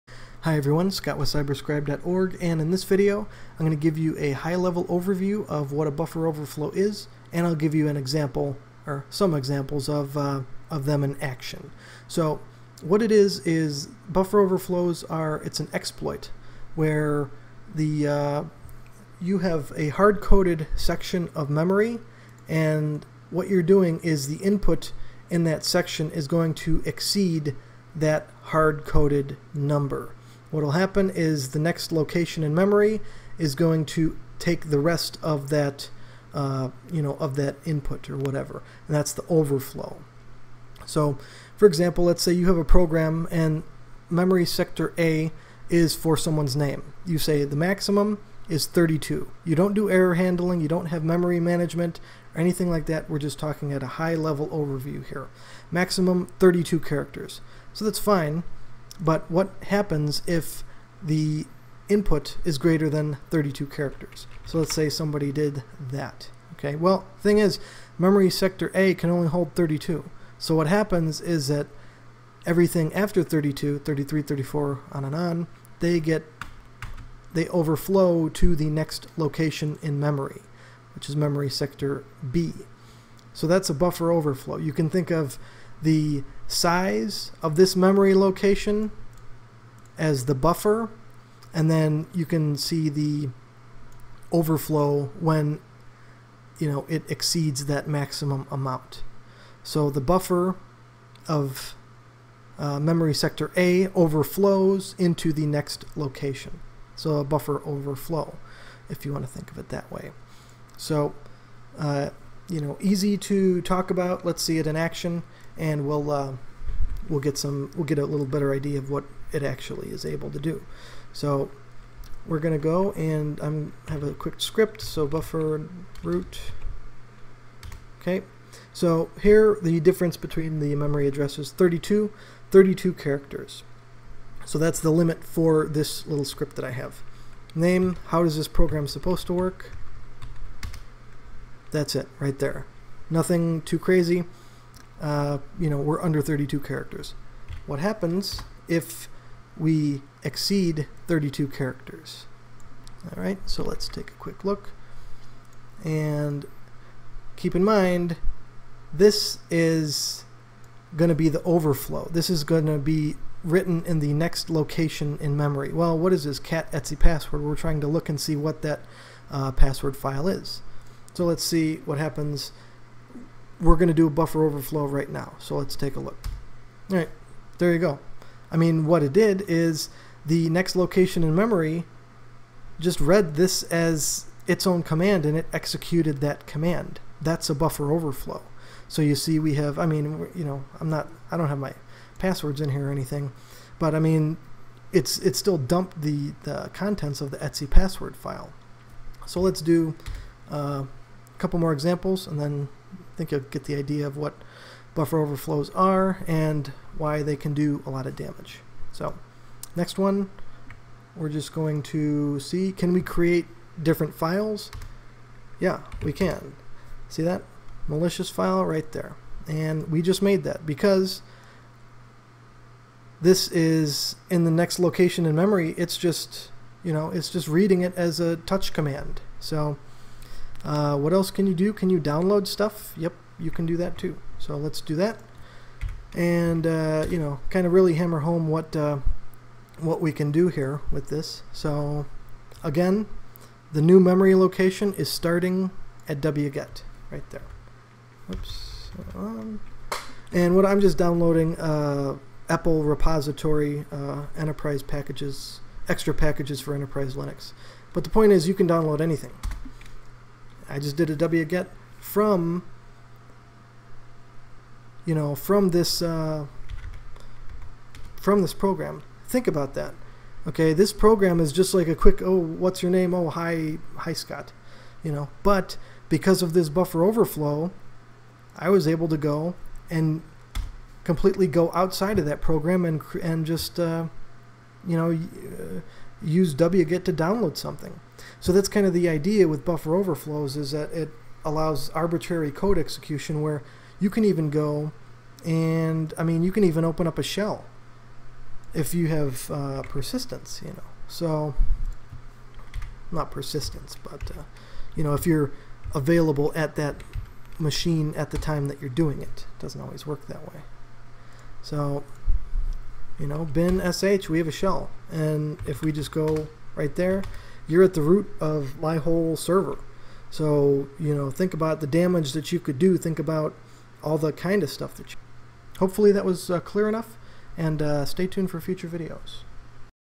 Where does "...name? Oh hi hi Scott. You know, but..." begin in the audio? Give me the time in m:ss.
4:32.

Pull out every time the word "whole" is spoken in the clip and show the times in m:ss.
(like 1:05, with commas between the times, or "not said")
5:18.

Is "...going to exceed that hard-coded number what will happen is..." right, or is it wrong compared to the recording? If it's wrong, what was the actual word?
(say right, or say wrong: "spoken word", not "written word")
right.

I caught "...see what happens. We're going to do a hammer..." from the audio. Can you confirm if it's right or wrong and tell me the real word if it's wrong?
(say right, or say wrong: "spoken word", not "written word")
wrong: "buffer", not "hammer".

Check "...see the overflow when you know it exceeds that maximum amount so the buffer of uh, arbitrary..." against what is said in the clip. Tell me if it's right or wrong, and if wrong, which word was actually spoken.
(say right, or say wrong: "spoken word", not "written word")
wrong: "memory", not "arbitrary".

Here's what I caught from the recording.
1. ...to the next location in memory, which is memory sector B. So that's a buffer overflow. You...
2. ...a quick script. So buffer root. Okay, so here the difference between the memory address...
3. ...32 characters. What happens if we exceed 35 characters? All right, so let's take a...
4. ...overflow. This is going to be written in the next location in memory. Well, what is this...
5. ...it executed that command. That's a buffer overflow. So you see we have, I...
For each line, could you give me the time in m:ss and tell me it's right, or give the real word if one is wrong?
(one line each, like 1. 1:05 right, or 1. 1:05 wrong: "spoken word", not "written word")
1. 1:18 right
2. 2:04 right
3. 2:26 wrong: "32", not "35"
4. 2:41 right
5. 3:05 right.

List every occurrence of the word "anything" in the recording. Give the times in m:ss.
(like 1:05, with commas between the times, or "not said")
0:52, 3:12, 4:19.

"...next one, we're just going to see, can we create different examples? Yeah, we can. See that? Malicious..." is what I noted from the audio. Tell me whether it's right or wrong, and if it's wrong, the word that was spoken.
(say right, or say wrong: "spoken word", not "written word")
wrong: "files", not "examples".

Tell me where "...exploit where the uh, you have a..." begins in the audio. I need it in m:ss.
0:15.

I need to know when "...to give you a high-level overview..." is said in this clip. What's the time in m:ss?
0:03.